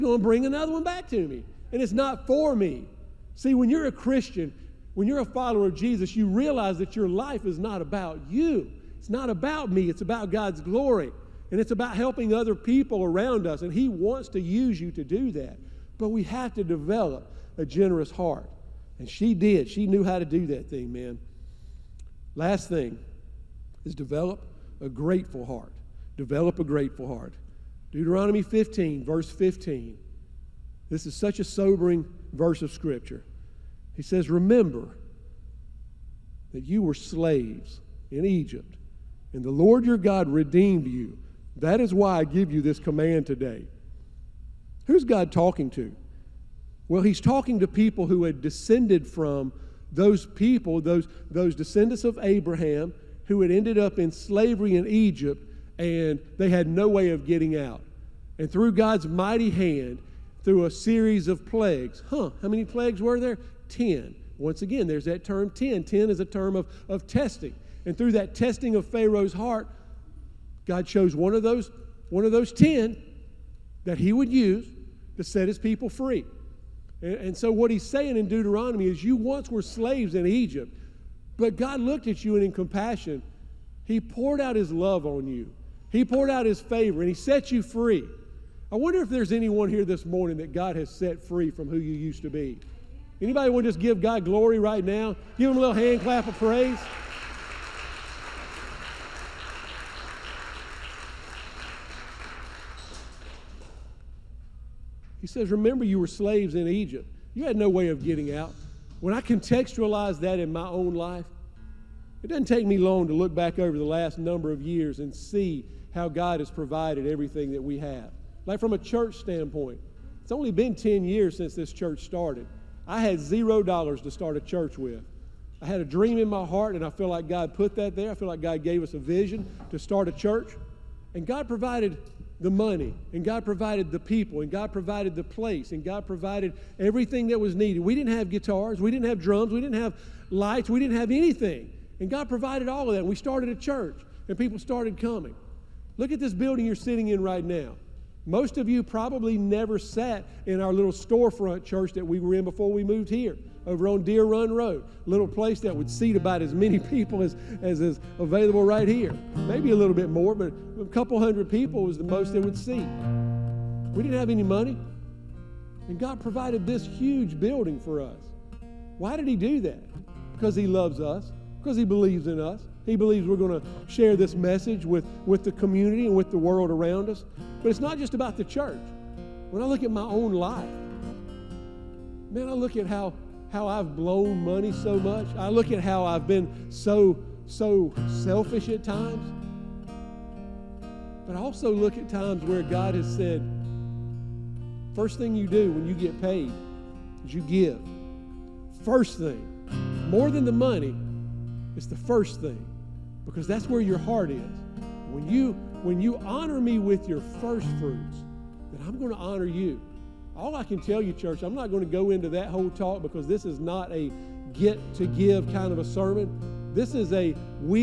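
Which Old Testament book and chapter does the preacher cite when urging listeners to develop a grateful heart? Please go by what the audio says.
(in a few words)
Deuteronomy 15.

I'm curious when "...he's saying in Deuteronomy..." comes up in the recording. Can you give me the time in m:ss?
1:17.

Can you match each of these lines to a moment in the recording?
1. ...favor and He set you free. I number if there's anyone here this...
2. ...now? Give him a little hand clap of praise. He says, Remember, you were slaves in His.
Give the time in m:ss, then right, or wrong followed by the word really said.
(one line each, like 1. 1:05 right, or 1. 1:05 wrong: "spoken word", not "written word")
1. 1:26 wrong: "wonder", not "number"
2. 1:34 wrong: "Egypt", not "His".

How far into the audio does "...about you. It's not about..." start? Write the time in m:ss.
0:07.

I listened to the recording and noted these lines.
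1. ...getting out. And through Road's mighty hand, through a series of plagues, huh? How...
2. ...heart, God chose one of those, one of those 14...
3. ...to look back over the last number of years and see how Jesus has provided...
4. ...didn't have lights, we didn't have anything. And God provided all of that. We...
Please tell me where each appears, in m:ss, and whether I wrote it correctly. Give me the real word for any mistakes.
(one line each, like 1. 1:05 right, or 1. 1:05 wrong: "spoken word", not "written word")
1. 0:57 wrong: "God", not "Road"
2. 1:09 wrong: "10", not "14"
3. 1:53 wrong: "God", not "Jesus"
4. 2:19 right.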